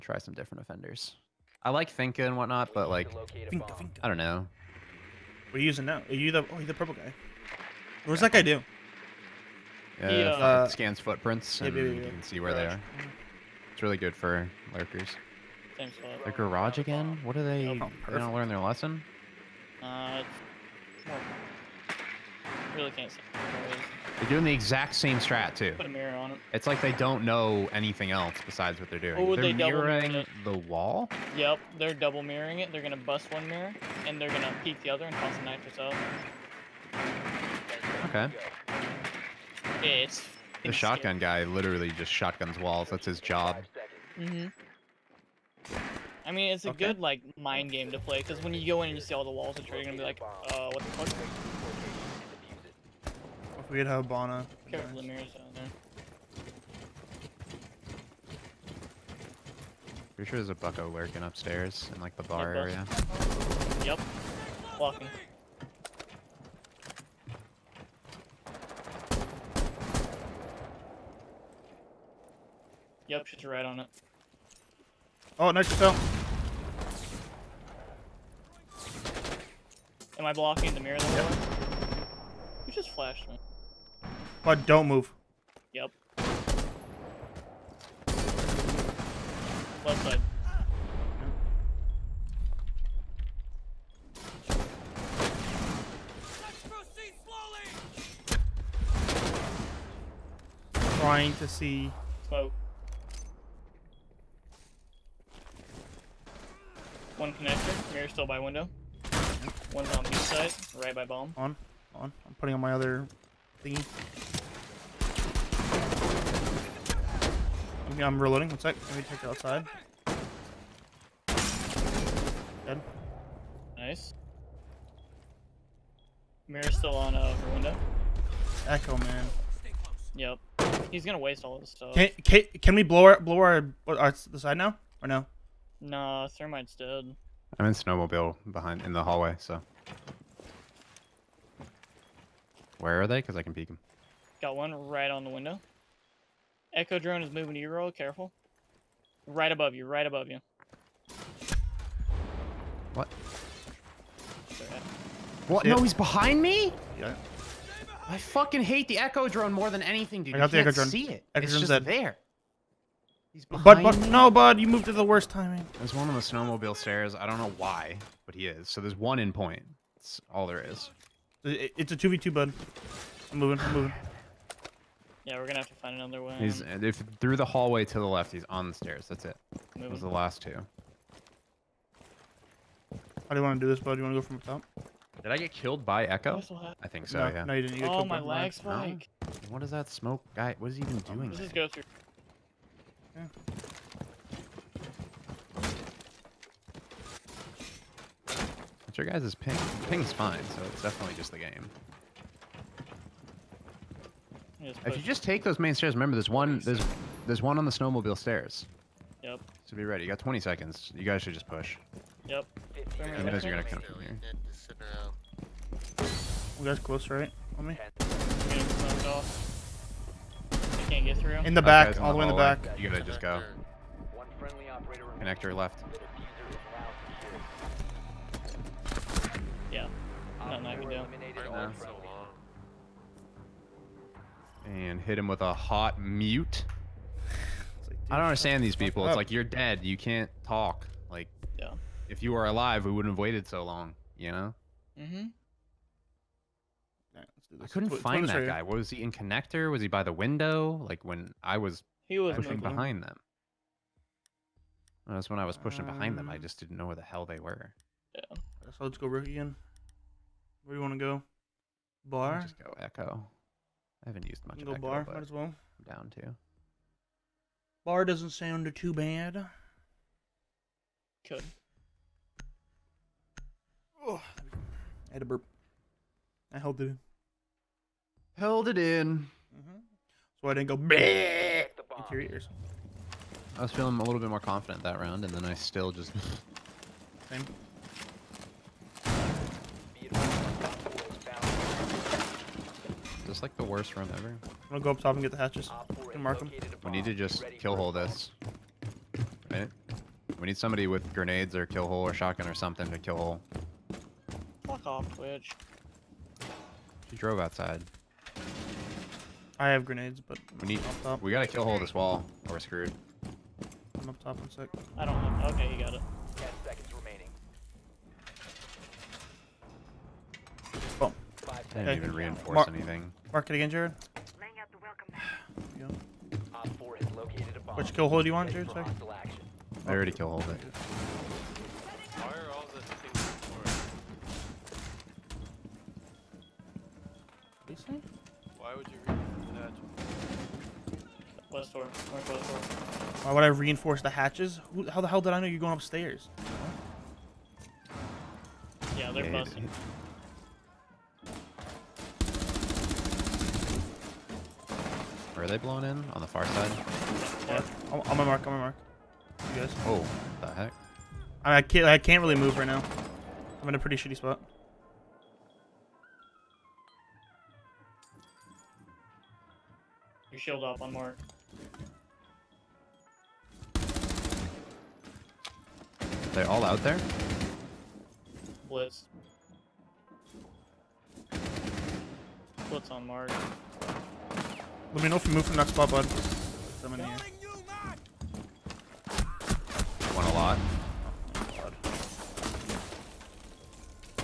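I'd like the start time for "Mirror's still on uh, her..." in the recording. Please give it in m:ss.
2:06.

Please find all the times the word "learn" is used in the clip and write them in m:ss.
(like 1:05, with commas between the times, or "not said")
0:18.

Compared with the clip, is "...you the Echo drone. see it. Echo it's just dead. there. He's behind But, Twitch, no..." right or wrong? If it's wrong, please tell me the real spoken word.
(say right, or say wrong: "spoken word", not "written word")
wrong: "Bud", not "Twitch".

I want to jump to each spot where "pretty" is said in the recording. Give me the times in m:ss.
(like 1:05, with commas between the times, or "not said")
1:00, 6:03.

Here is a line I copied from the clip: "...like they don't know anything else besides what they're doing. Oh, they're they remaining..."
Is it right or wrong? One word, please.
wrong.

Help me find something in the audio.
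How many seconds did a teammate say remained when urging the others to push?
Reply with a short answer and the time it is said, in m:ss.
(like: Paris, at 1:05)
20, at 3:30.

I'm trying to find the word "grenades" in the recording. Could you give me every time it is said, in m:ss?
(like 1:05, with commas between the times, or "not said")
5:01, 5:09.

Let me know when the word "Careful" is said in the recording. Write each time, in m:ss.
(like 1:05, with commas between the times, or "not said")
0:54, 2:27.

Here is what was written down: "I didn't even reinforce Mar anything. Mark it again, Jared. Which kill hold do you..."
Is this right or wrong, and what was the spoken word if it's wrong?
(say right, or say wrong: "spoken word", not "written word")
right.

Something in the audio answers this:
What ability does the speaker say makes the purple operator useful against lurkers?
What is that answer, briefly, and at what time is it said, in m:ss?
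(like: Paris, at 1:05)
Scans footprints, at 0:10.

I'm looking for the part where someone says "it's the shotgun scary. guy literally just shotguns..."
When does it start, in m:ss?
0:39.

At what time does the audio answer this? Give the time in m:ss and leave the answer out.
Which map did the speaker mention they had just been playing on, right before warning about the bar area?
0:53.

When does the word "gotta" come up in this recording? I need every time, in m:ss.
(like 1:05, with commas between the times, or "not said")
3:42, 5:11.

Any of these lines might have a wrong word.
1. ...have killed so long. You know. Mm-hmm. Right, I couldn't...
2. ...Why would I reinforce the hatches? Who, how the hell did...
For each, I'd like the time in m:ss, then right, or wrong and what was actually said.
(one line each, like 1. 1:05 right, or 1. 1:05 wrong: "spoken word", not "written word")
1. 4:03 wrong: "waited", not "killed"
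2. 5:43 right.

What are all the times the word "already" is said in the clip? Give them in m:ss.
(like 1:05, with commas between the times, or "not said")
5:29.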